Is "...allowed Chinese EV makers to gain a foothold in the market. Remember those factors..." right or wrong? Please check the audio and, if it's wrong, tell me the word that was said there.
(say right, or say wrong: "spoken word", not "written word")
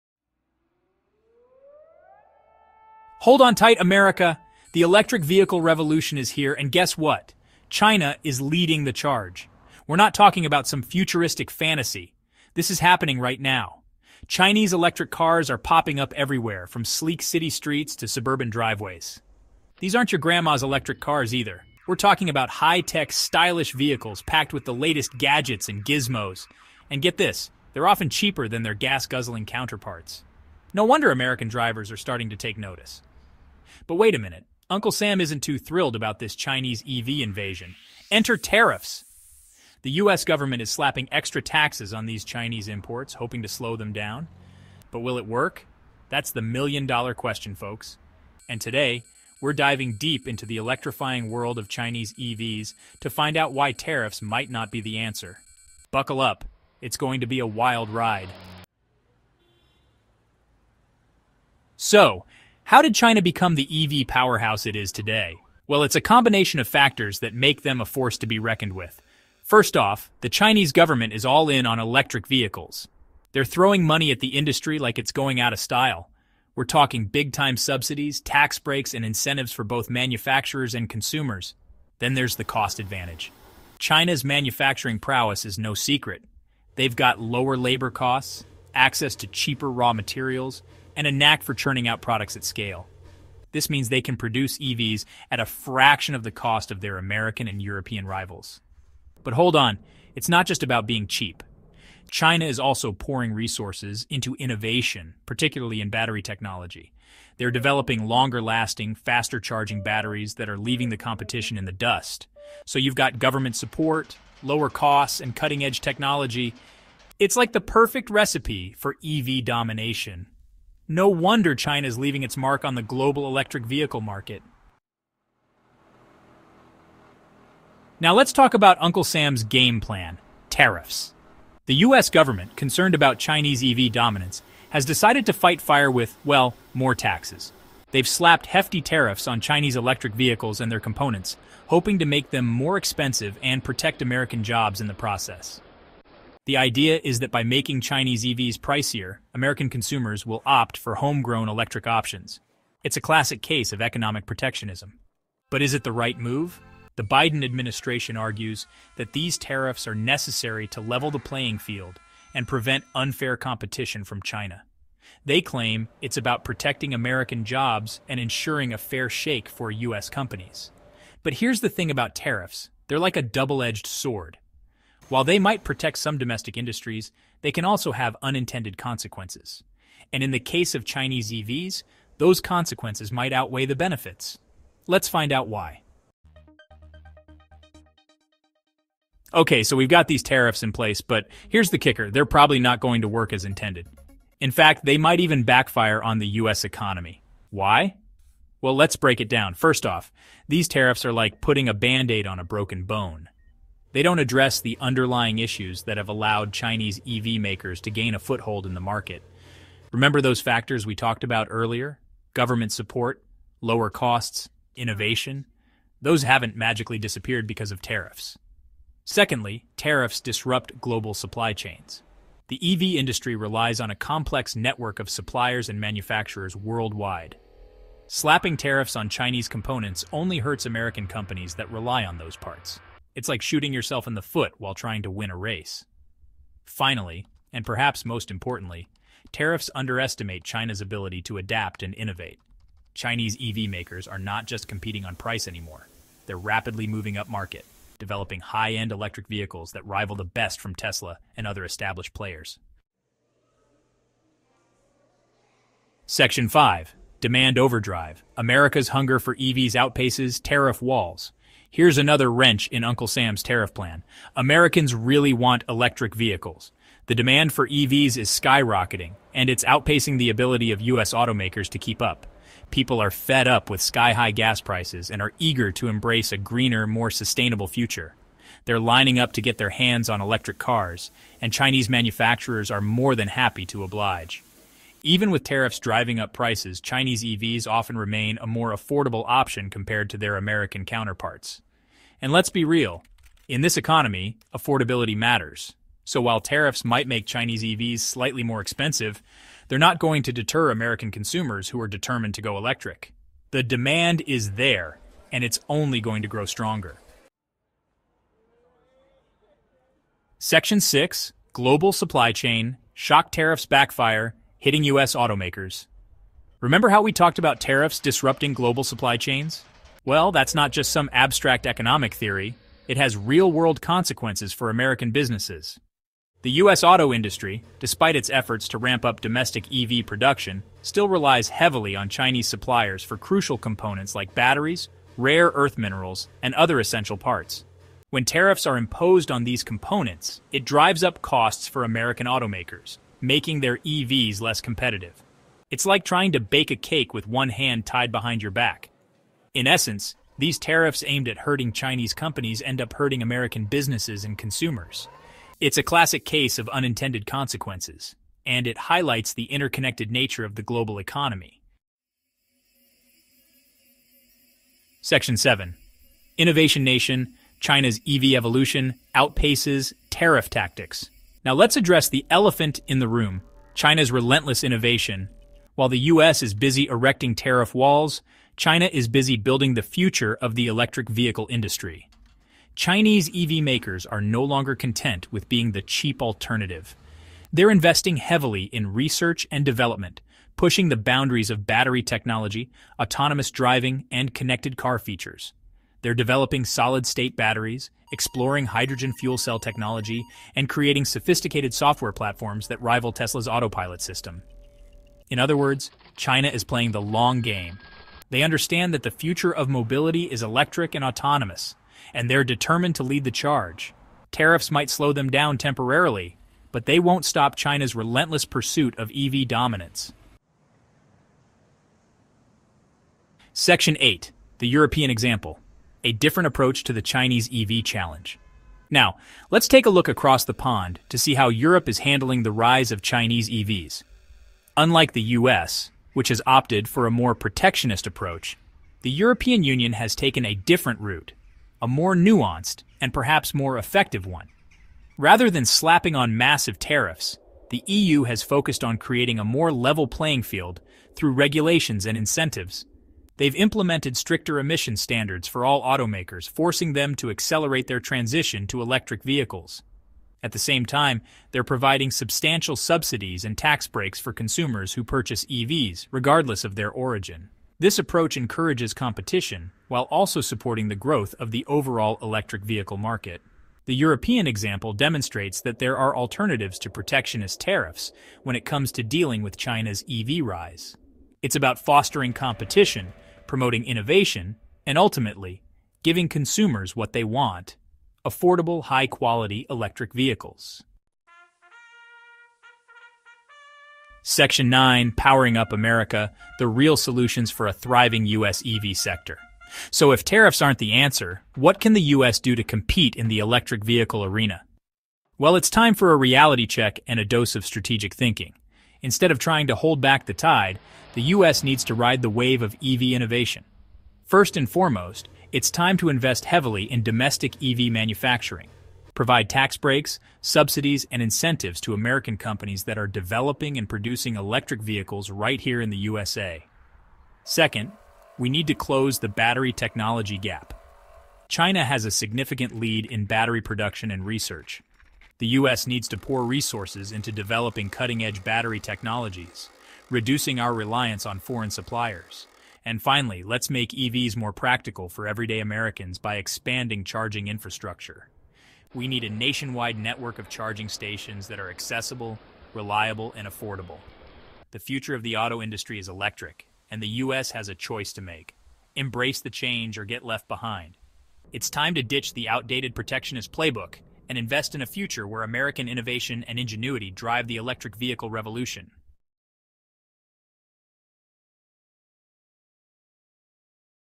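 right.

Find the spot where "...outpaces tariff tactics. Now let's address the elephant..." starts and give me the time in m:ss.
6:09.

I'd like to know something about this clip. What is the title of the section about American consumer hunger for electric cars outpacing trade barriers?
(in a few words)
Demand Overdrive.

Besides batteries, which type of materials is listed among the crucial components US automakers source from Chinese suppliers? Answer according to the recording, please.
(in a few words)
Rare earth minerals.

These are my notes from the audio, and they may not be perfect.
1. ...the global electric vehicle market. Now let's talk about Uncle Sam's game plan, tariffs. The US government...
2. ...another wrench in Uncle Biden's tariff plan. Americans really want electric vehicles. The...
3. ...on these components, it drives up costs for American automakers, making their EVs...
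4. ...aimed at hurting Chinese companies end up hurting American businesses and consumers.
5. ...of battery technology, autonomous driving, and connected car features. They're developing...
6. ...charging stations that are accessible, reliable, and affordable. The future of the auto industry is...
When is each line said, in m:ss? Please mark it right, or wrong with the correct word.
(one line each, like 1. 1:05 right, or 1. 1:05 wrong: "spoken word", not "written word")
1. 2:02 right
2. 4:21 wrong: "Sam", not "Biden"
3. 5:39 right
4. 5:51 right
5. 6:31 right
6. 9:10 right.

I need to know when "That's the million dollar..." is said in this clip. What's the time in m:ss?
0:46.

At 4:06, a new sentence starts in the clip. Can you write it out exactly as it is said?
They're rapidly moving up market, developing high-end electric vehicles that rival the best from Tesla and other established players.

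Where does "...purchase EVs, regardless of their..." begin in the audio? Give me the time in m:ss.
7:45.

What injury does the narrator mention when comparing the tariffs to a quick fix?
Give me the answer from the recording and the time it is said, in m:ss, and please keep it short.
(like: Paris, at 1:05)
Broken bone, at 3:22.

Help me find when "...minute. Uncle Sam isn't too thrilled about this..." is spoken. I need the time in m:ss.
0:34.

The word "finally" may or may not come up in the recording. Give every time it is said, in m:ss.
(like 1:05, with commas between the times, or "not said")
3:56, 9:03.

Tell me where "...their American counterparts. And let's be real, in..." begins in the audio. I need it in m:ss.
4:50.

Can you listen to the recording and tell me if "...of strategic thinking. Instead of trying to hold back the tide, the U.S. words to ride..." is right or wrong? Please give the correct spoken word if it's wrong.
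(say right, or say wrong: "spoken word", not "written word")
wrong: "needs", not "words".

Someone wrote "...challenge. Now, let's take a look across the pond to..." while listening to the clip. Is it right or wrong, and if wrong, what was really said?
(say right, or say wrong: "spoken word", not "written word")
right.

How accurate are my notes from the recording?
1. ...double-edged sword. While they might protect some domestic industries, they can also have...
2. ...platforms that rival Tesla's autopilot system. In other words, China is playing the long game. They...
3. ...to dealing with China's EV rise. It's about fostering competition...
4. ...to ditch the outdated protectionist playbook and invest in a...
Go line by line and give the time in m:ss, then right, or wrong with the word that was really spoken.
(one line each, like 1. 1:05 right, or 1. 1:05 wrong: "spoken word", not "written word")
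1. 2:53 right
2. 6:42 right
3. 7:58 right
4. 9:21 right.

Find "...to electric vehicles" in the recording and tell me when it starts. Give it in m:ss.
7:38.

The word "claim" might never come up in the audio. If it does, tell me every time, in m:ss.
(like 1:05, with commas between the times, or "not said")
2:45.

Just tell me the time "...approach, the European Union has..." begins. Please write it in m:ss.
7:18.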